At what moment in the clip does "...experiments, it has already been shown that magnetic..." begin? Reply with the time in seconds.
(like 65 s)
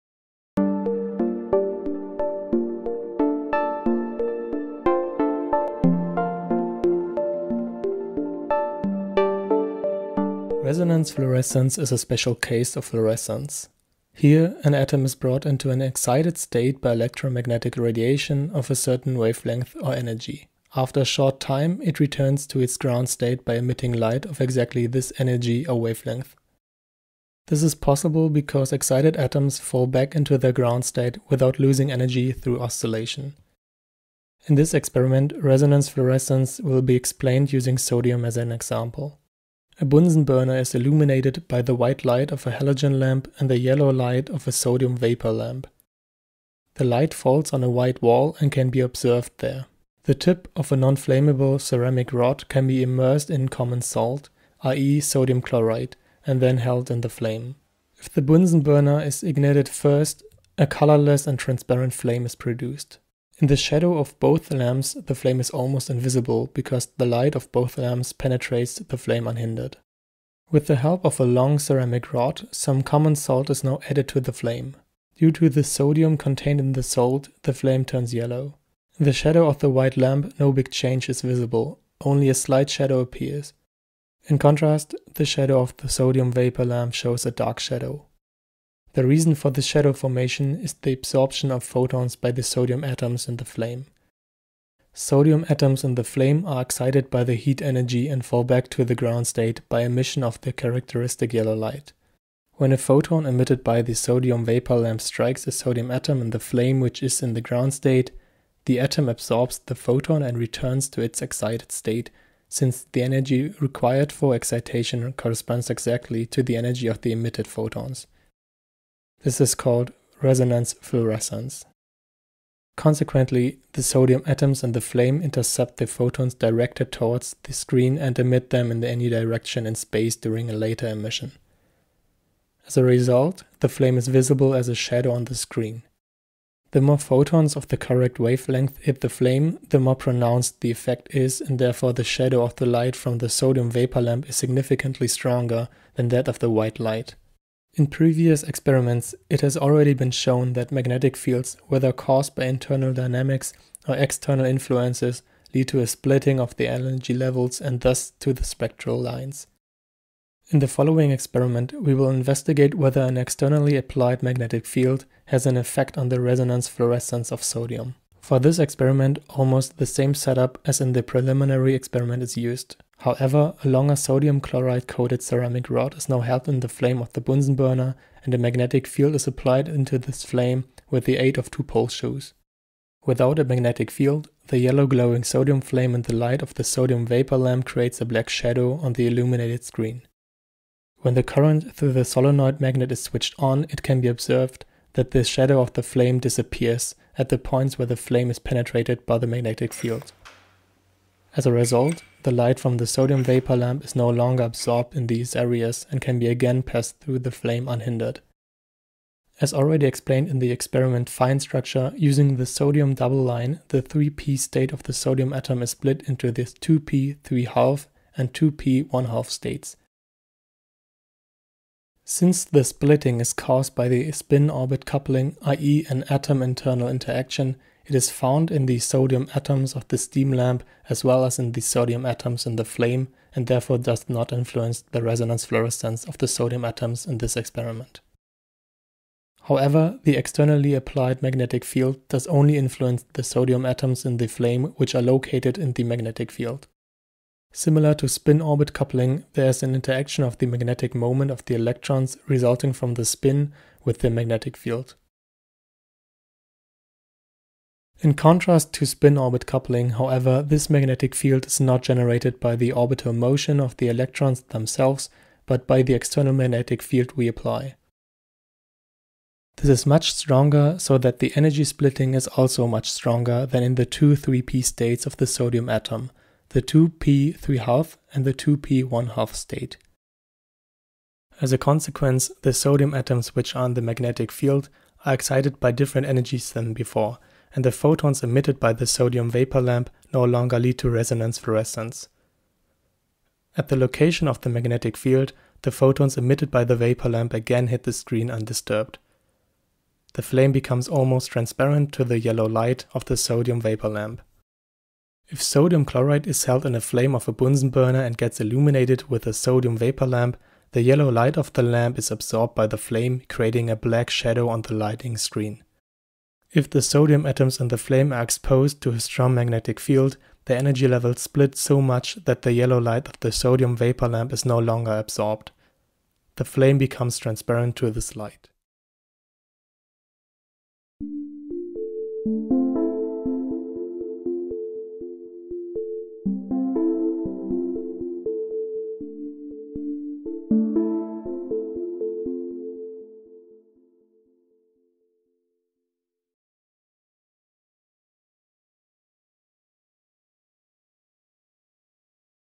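148 s.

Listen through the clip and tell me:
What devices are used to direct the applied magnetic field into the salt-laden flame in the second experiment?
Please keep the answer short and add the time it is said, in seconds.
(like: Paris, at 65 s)
two pole shoes, at 181 s.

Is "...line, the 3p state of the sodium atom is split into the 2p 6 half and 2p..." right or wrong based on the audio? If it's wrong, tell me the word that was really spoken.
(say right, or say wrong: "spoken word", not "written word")
wrong: "3", not "6".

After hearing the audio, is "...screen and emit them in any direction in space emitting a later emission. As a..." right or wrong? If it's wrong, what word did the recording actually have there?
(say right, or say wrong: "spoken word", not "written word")
wrong: "during", not "emitting".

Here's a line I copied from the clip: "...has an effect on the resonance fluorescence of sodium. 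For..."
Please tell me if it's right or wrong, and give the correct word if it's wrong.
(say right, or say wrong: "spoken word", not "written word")
right.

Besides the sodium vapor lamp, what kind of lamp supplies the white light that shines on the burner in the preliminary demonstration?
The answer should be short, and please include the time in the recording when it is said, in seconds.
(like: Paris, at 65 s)
halogen lamp, at 42 s.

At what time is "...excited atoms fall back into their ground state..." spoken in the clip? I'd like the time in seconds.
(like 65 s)
28 s.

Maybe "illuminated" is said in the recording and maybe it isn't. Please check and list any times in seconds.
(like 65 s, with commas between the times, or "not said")
40 s, 189 s, 308 s.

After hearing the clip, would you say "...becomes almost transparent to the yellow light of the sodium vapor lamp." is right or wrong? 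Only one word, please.
right.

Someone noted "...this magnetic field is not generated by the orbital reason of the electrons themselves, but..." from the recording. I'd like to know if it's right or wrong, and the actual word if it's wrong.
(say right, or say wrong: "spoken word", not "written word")
wrong: "motion", not "reason".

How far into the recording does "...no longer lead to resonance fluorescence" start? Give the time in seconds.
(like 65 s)
290 s.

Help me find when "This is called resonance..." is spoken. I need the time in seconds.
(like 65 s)
119 s.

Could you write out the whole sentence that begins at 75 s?
Due to the sodium contained in the salt, the flame turns yellow.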